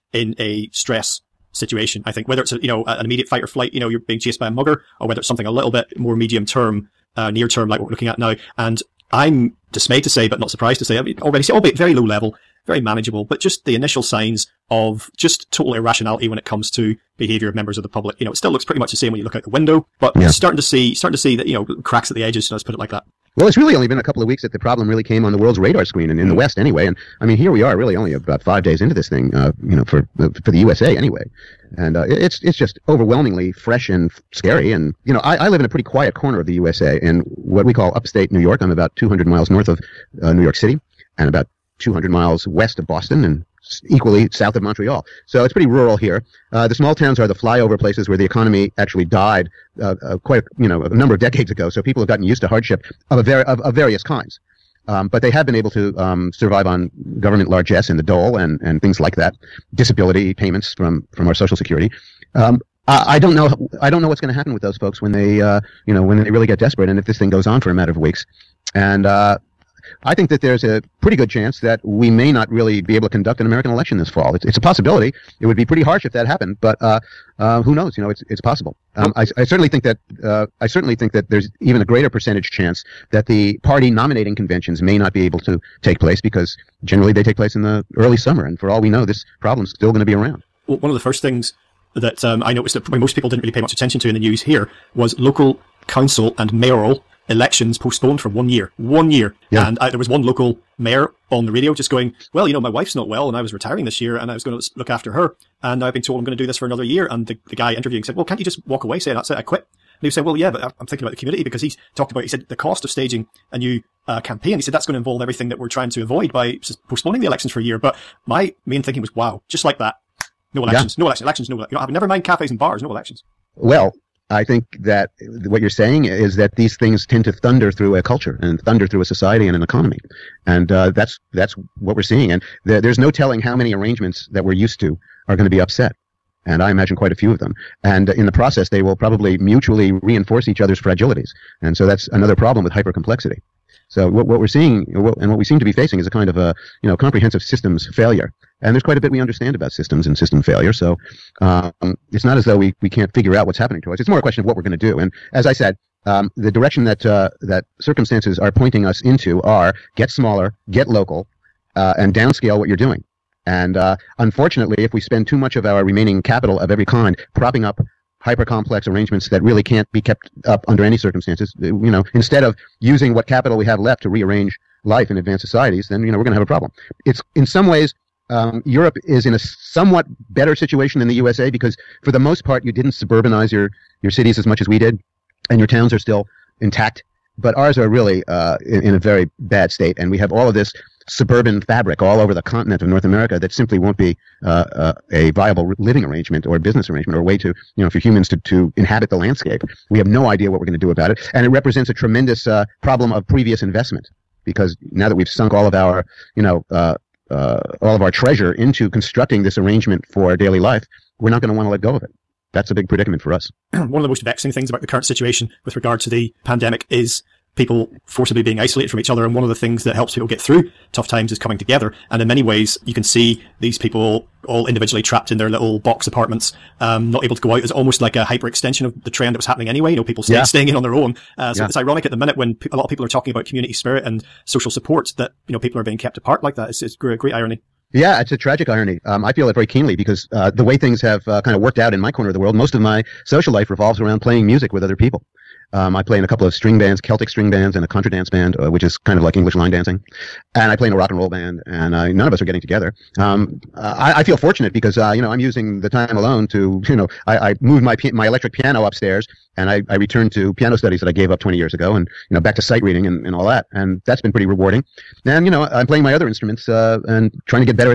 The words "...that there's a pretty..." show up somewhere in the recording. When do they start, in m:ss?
1:10.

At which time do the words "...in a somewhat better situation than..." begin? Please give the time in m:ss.
2:59.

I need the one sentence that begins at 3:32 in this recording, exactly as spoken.
That's a big predicament for us.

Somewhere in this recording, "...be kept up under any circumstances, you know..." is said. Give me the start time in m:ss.
2:49.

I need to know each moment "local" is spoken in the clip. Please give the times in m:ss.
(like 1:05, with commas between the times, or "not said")
1:35, 1:40, 2:40.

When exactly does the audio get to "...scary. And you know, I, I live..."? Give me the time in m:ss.
0:34.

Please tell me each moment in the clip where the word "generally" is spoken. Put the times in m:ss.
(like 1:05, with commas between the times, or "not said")
1:26.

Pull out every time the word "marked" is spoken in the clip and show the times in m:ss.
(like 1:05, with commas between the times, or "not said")
not said.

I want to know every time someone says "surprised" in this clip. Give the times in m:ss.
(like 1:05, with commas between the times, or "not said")
0:10.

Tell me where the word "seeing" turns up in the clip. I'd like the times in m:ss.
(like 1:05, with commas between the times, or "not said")
2:12, 2:24.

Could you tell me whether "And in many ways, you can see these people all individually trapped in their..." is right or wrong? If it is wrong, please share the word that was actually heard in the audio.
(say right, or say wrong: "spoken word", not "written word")
right.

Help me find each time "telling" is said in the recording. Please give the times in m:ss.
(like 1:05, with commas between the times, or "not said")
2:13.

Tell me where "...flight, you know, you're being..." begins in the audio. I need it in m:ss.
0:03.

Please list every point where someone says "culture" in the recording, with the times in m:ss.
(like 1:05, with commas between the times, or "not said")
2:08.